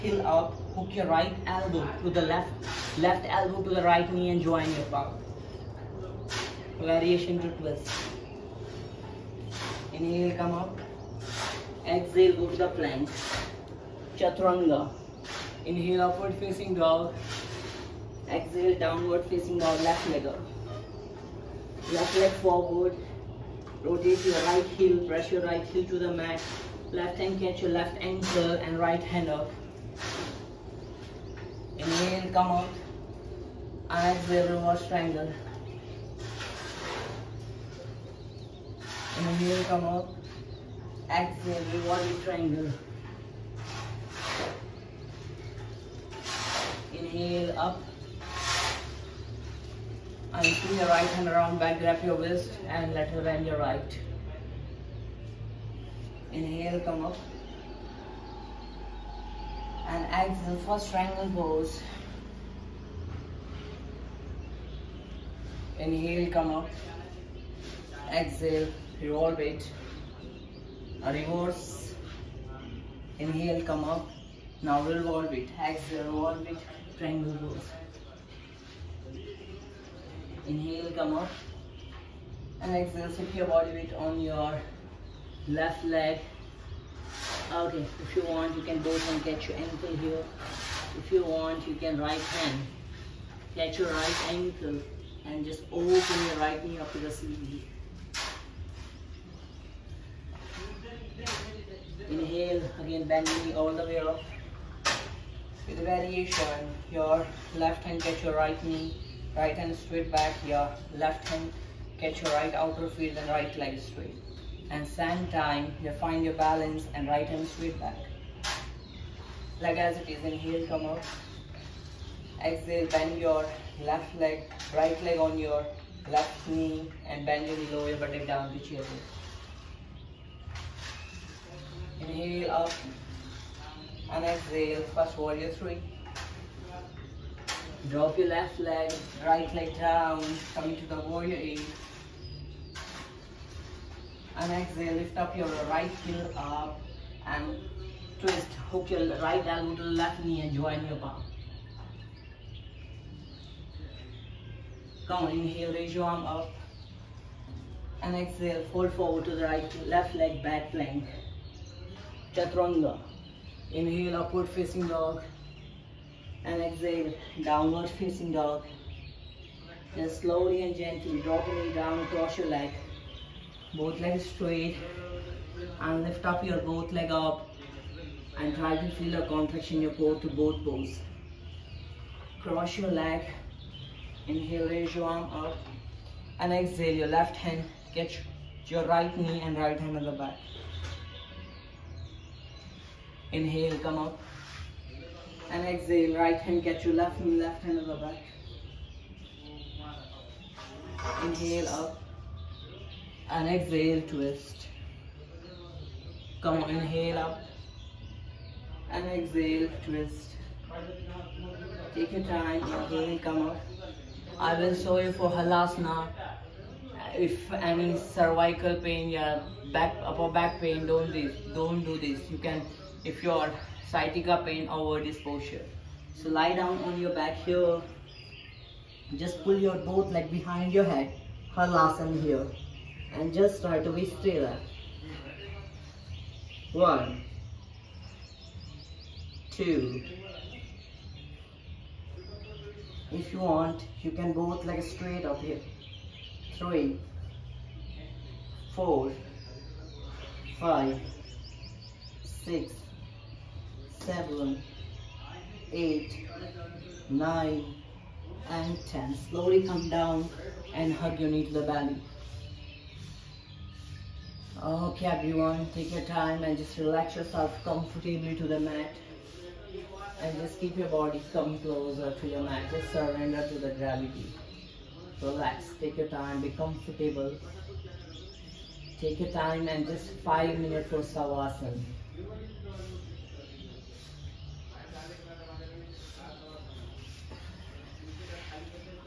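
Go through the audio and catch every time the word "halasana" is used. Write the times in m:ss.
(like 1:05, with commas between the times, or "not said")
3:35, 3:51.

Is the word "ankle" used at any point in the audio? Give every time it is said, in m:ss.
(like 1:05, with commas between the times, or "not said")
0:28, 1:29, 1:34.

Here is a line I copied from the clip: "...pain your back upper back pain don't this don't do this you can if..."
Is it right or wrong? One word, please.
right.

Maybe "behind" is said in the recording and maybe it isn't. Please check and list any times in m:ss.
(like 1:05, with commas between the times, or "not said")
3:50.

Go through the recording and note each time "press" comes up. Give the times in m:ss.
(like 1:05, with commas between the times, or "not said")
0:25.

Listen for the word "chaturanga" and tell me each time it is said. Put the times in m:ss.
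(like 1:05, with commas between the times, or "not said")
0:14, 2:42.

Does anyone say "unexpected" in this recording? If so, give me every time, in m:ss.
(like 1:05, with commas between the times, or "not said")
not said.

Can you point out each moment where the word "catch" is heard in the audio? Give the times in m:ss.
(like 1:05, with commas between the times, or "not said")
0:27, 1:51, 3:07.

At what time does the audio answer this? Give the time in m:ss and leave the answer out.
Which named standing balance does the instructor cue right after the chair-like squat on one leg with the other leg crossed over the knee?
2:15.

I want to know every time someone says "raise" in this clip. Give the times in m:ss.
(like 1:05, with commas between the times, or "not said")
2:35, 3:04.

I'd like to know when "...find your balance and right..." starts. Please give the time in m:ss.
1:56.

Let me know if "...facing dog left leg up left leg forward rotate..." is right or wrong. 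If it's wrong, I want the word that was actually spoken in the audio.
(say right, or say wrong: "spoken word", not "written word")
right.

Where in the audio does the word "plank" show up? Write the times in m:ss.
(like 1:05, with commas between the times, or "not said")
0:12, 2:40.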